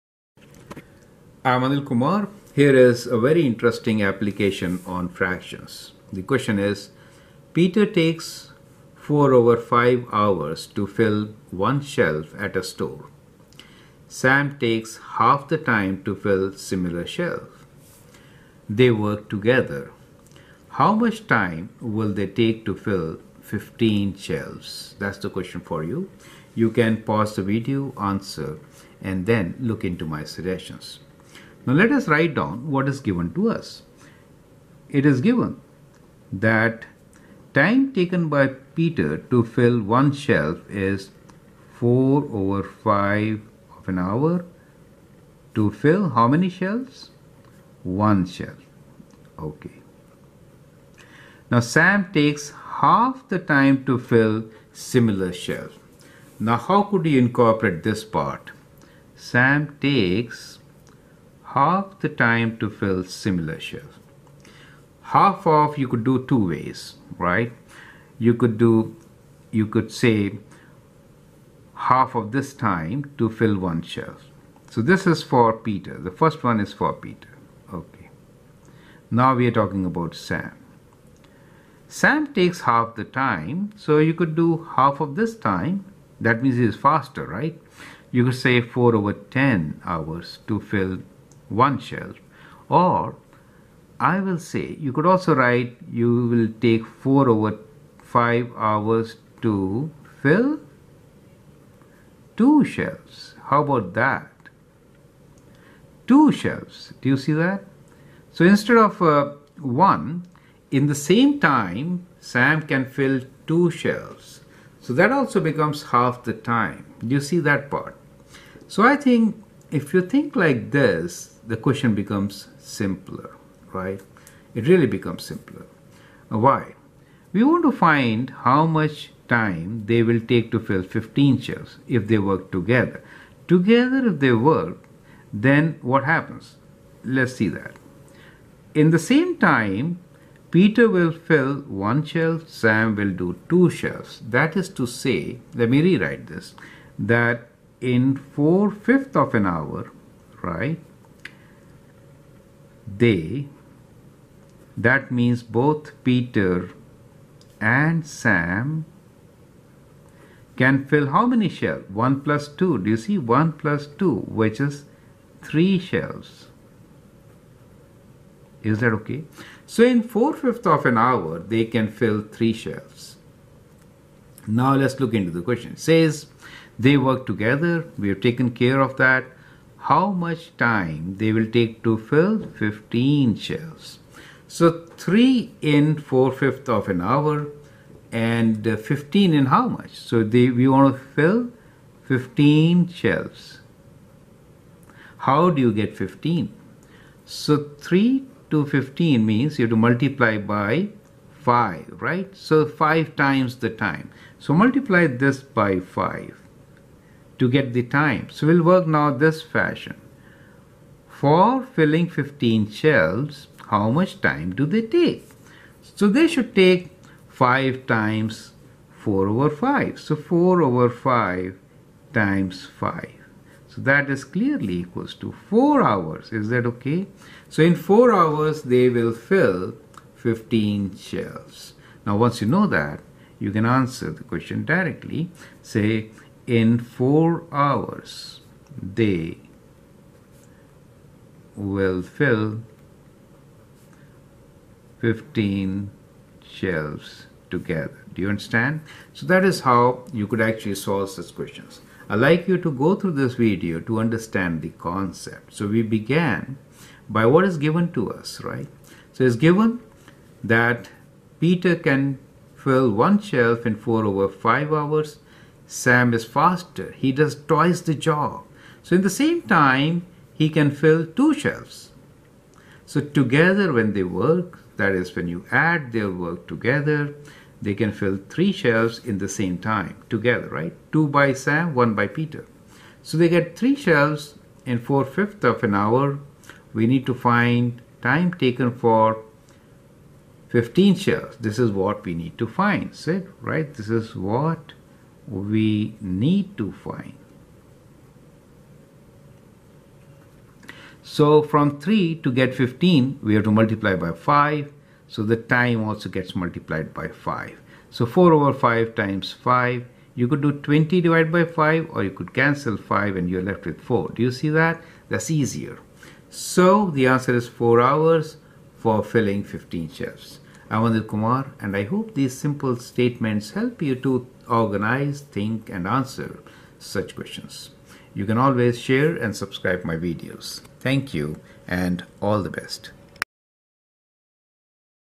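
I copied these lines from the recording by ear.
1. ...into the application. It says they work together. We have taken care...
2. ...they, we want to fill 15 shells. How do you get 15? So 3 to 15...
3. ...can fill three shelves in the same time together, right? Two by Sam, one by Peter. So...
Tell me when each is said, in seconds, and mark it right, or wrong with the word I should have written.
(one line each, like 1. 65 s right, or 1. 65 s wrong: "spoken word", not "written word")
1. 175 s wrong: "question", not "application"
2. 190 s right
3. 277 s right.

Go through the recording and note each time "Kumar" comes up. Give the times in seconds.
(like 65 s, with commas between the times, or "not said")
1 s, 321 s.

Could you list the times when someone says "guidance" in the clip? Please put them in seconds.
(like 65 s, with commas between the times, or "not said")
not said.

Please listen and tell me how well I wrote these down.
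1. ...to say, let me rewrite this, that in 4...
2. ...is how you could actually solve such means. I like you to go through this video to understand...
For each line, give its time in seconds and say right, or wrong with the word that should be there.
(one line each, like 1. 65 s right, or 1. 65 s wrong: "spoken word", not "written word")
1. 144 s right
2. 249 s wrong: "questions", not "means".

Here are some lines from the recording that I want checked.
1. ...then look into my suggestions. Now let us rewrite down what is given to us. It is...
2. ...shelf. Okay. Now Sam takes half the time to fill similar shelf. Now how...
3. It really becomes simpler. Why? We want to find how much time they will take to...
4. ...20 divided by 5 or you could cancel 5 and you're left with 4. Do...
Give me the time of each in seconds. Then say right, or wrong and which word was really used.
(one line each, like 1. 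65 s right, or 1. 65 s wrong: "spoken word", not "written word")
1. 29 s wrong: "write", not "rewrite"
2. 48 s right
3. 124 s right
4. 310 s right.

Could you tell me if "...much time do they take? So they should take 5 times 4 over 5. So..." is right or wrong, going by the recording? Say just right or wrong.
right.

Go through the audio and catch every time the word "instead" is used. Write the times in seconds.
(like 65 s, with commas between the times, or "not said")
108 s.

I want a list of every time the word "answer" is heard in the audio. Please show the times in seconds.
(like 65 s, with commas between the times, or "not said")
27 s, 233 s, 317 s, 325 s.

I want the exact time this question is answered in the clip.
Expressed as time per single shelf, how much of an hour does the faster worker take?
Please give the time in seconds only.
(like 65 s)
88 s.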